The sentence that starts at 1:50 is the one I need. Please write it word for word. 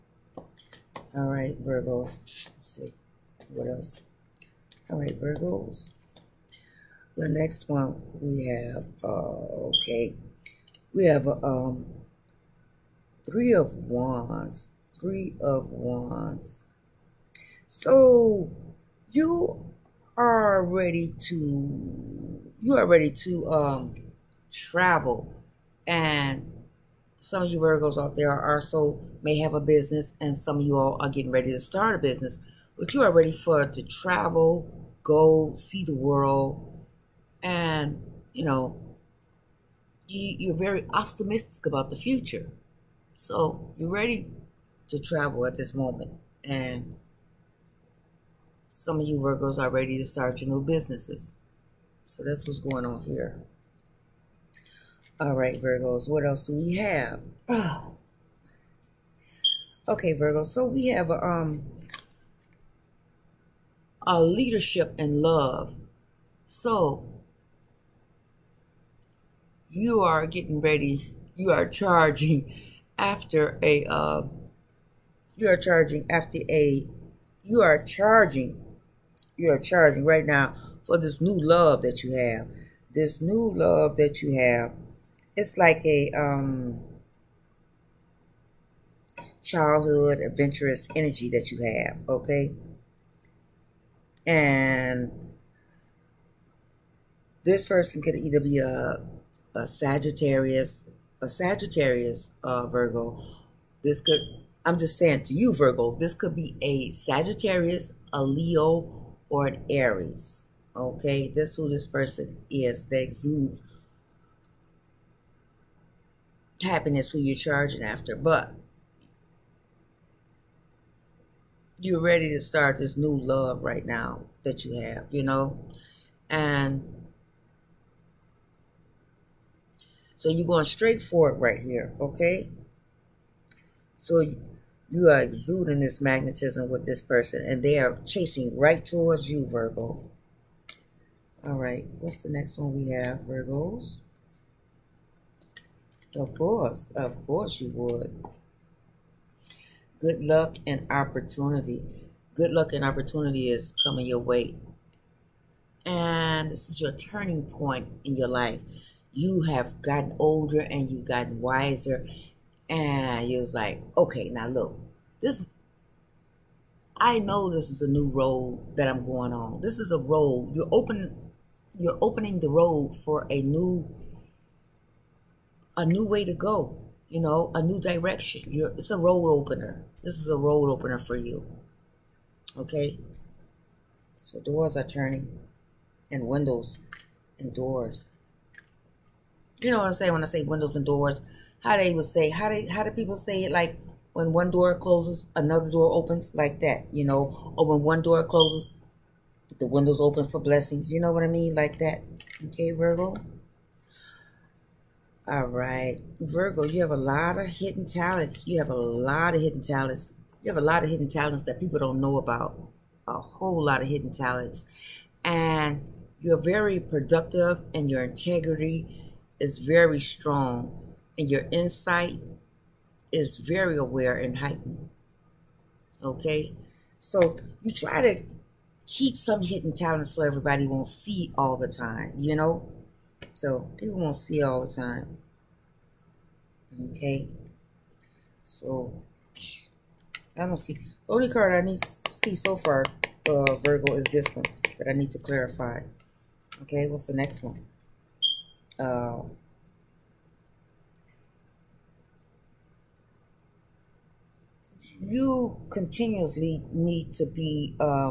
Okay, that's who this person is that exudes happiness, who you're charging after.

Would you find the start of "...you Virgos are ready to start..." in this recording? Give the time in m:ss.
0:49.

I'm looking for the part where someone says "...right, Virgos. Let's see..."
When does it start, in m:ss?
0:01.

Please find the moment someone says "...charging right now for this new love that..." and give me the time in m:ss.
1:19.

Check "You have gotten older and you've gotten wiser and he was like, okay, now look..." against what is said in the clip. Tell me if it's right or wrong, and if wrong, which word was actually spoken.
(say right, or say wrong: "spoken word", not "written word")
right.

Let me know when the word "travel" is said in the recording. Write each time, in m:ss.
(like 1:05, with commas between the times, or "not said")
0:24, 0:33, 0:44.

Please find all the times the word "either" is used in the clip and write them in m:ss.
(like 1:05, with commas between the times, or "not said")
1:38.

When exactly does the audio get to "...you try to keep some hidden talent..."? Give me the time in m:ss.
3:47.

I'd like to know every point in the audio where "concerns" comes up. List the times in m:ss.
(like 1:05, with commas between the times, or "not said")
not said.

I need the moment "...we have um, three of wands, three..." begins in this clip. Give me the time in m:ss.
0:10.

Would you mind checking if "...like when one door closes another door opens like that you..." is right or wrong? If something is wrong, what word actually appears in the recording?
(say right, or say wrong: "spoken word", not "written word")
right.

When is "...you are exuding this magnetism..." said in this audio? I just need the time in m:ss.
2:14.